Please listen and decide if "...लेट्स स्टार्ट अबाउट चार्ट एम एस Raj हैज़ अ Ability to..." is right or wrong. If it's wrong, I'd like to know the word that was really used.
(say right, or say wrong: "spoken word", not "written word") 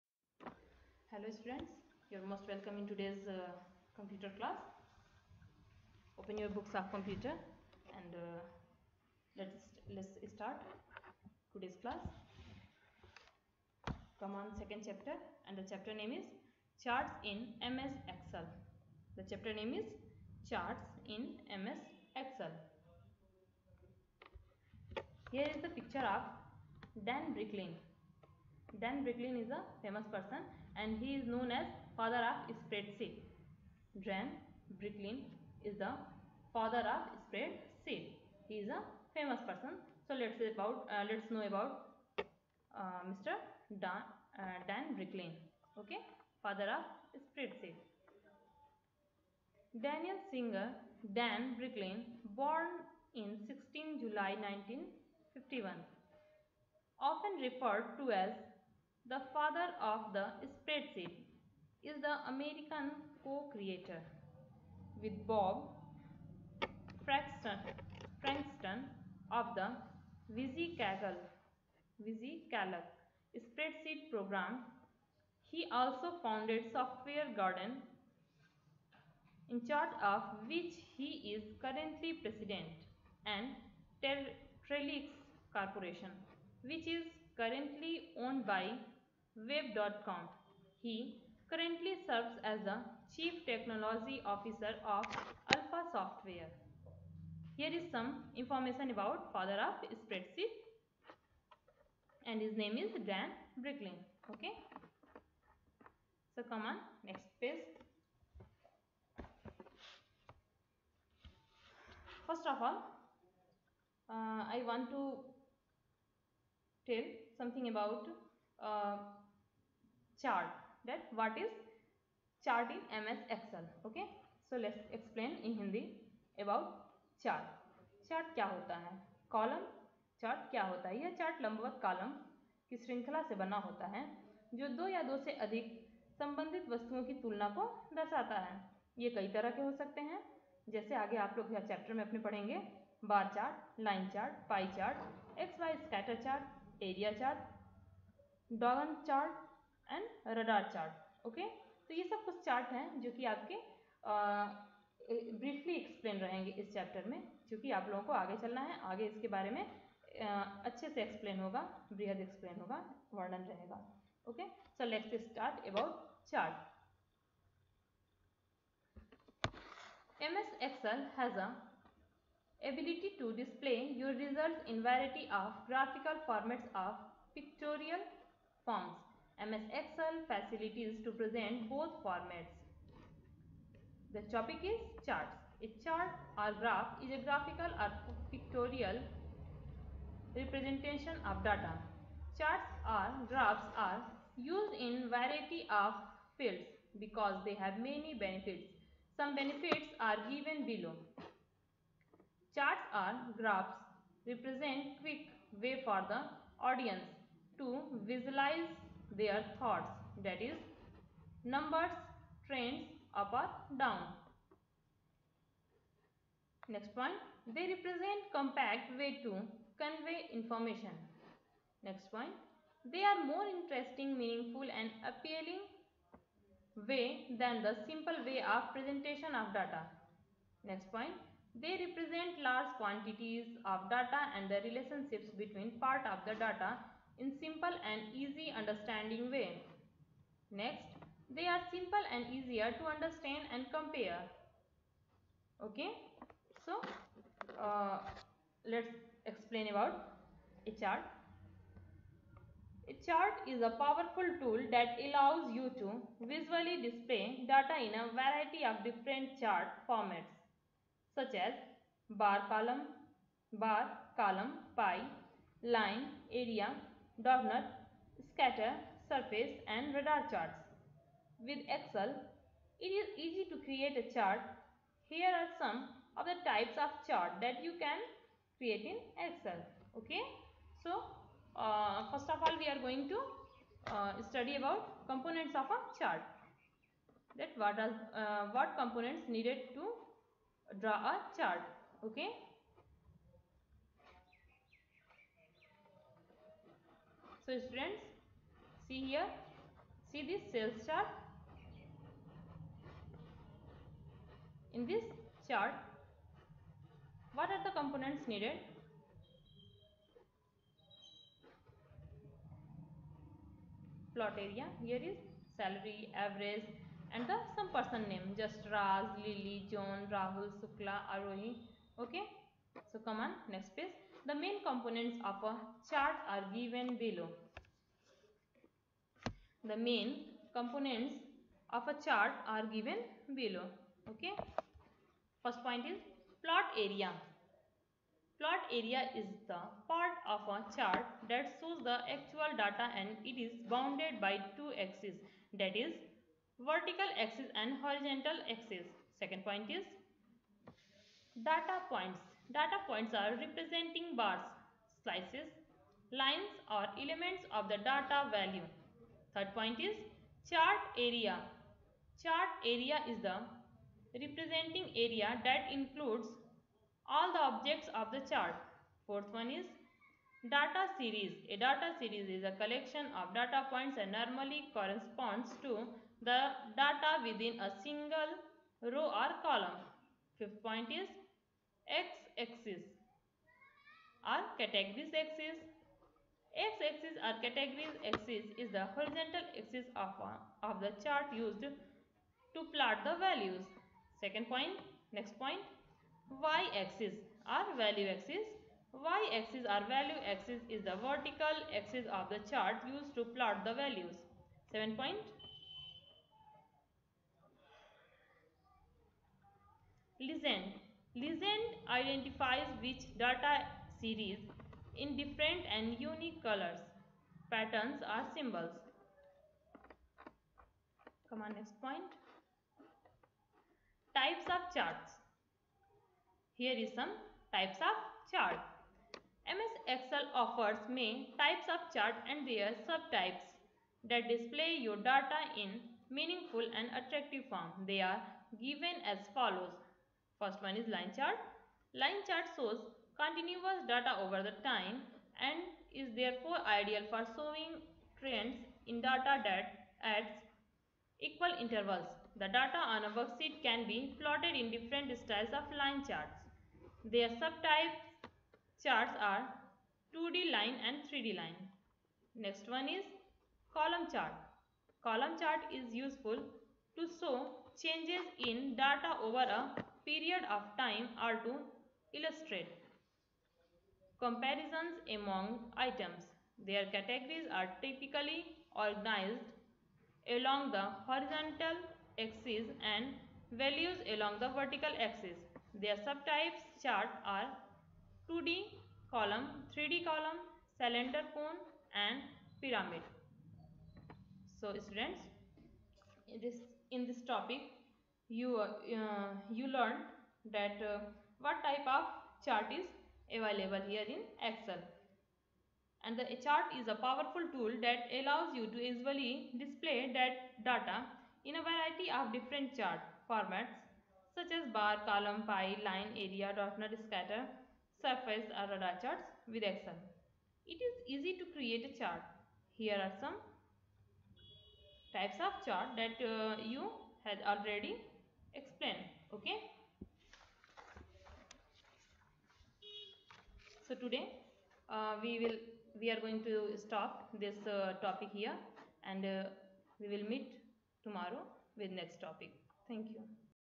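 wrong: "Excel", not "Raj".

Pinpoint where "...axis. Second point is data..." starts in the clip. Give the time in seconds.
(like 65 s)
348 s.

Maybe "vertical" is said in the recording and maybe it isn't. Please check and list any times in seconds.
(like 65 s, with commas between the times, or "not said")
346 s, 401 s, 484 s.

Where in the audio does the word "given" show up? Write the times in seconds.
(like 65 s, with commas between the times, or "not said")
200 s, 326 s, 332 s, 438 s.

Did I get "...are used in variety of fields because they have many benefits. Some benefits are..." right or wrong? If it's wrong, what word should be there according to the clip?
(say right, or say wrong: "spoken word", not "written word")
right.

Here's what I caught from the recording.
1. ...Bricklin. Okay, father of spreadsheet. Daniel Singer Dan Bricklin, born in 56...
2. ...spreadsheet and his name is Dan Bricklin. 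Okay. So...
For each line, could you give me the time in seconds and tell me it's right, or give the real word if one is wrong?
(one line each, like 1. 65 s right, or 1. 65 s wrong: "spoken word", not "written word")
1. 44 s wrong: "16", not "56"
2. 100 s right.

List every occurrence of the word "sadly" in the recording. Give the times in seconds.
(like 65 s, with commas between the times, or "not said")
not said.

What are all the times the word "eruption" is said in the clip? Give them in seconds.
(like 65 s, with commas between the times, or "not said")
not said.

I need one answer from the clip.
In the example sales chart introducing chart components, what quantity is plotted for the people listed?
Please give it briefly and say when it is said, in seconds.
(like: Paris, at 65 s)
salary average, at 315 s.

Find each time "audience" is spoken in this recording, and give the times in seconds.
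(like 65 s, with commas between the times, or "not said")
206 s.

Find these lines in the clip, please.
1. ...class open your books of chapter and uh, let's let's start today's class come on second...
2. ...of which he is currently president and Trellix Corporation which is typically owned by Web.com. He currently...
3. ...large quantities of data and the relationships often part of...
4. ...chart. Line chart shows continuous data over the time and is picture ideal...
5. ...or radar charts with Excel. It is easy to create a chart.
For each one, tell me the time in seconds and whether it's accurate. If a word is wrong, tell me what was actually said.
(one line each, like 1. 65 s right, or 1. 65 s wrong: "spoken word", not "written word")
1. 4 s wrong: "computer", not "chapter"
2. 80 s wrong: "currently", not "typically"
3. 232 s wrong: "between", not "often"
4. 441 s wrong: "therefore", not "picture"
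5. 518 s right.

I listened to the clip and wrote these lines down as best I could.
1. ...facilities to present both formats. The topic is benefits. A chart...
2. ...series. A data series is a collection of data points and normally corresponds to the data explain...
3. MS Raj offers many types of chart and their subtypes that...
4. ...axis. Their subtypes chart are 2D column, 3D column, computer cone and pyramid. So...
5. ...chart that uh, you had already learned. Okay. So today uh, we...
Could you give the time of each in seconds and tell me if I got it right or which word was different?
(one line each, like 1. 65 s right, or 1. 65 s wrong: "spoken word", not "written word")
1. 180 s wrong: "charts", not "benefits"
2. 370 s wrong: "within", not "explain"
3. 429 s wrong: "Excel", not "Raj"
4. 484 s wrong: "cylinder", not "computer"
5. 525 s wrong: "explained", not "learned".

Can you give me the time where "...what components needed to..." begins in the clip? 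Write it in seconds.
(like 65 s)
288 s.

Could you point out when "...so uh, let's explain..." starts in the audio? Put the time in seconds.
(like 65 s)
246 s.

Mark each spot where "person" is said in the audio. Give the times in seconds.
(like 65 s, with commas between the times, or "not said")
30 s, 39 s, 317 s.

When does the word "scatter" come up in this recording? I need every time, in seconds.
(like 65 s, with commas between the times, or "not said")
268 s, 517 s.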